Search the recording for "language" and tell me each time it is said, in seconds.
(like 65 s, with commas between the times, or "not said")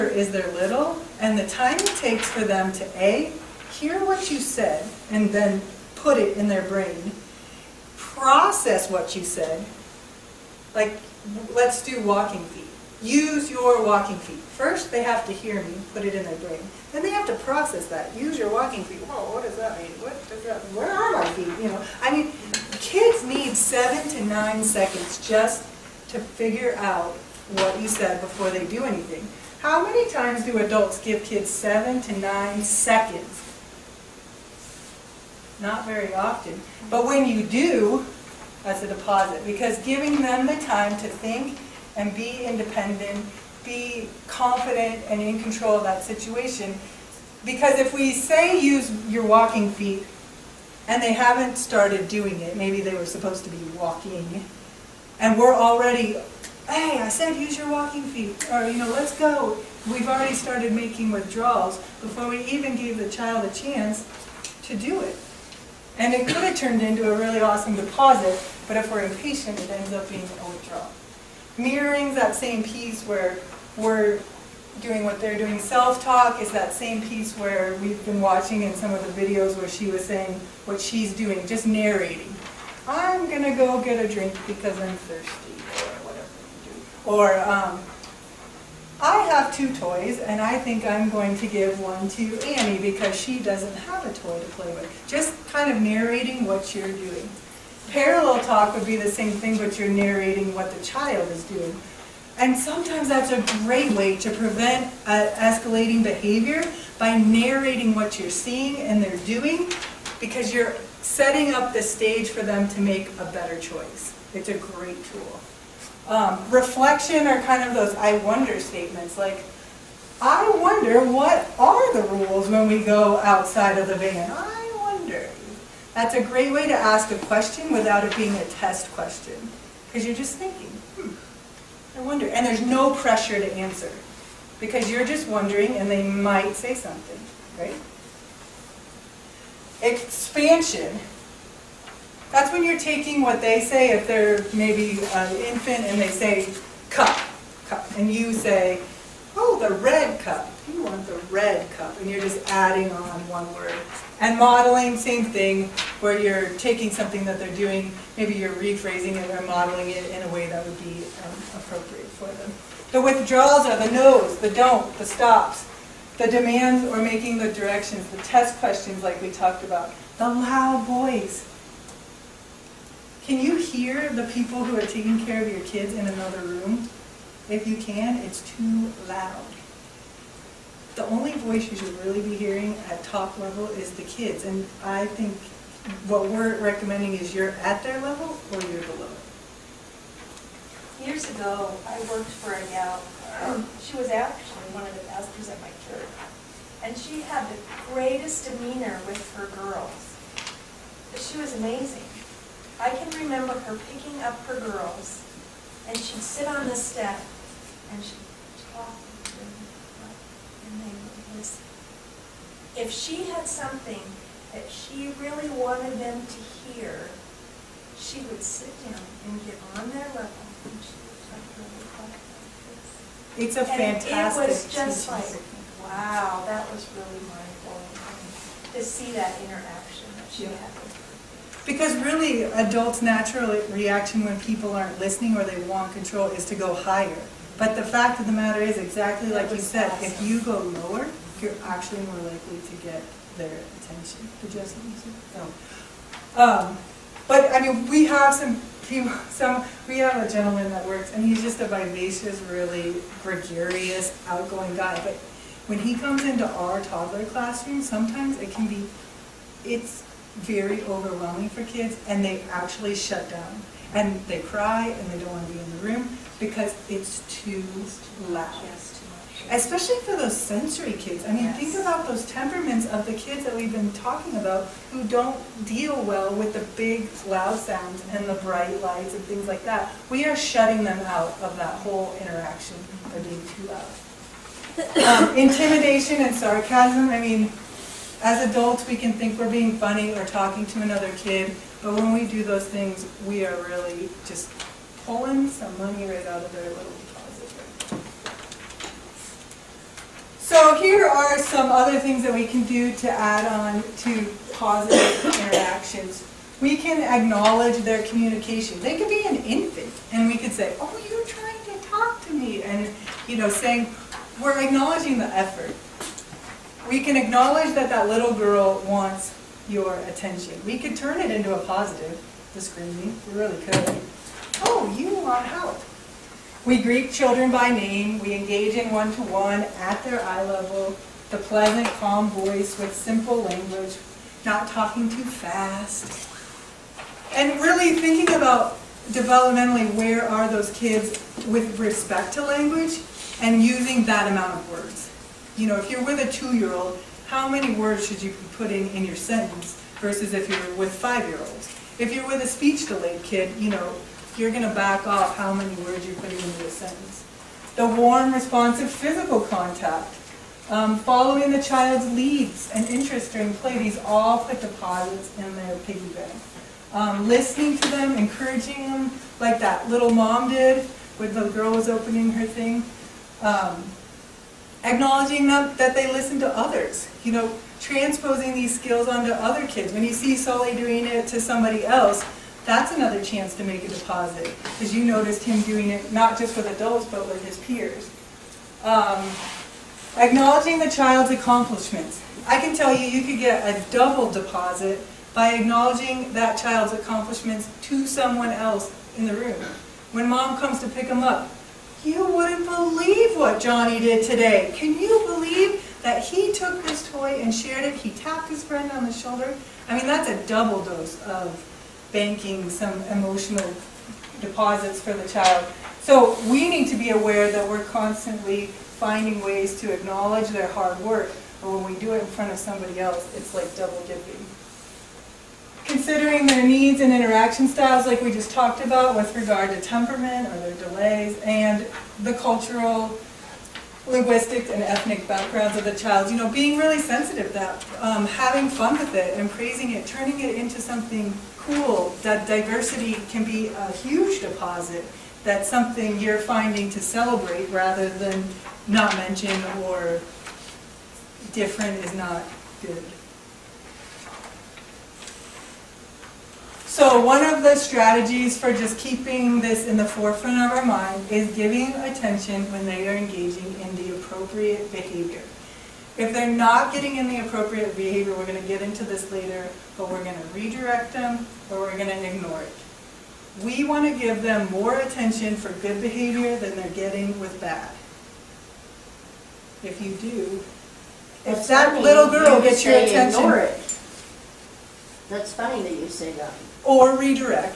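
333 s, 342 s.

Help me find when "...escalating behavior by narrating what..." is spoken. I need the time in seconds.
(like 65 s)
105 s.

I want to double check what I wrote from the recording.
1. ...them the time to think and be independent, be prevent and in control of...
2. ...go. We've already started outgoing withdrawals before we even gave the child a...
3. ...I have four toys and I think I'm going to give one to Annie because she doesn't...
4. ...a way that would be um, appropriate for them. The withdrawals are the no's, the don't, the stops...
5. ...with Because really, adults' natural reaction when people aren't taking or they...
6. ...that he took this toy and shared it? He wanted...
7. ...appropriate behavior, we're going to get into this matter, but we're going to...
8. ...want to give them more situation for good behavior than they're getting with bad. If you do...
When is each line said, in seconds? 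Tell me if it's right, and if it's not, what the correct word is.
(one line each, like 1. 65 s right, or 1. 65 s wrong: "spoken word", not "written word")
1. 40 s wrong: "confident", not "prevent"
2. 59 s wrong: "making", not "outgoing"
3. 88 s wrong: "two", not "four"
4. 160 s right
5. 230 s wrong: "listening", not "taking"
6. 406 s wrong: "tapped", not "wanted"
7. 467 s wrong: "later", not "matter"
8. 473 s wrong: "attention", not "situation".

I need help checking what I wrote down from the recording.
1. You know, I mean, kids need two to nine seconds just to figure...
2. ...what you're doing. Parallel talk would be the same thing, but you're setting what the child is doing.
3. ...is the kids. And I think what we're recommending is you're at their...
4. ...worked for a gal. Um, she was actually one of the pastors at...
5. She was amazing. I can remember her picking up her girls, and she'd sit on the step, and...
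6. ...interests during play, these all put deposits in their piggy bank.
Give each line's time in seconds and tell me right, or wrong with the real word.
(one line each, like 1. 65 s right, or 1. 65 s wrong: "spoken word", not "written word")
1. 21 s wrong: "seven", not "two"
2. 96 s wrong: "narrating", not "setting"
3. 183 s right
4. 192 s right
5. 201 s right
6. 362 s right.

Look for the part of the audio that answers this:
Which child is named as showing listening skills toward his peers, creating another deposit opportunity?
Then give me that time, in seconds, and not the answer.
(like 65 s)
380 s.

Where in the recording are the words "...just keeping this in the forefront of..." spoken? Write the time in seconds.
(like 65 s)
458 s.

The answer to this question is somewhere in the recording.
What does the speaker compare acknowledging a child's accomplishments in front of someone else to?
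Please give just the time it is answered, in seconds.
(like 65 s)
423 s.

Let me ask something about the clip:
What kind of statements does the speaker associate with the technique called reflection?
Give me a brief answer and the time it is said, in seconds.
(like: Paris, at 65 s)
I wonder statements, at 117 s.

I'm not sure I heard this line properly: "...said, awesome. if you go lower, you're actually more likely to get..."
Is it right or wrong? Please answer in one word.
right.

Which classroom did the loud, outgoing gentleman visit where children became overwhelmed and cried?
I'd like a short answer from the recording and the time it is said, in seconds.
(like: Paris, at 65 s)
toddler classroom, at 256 s.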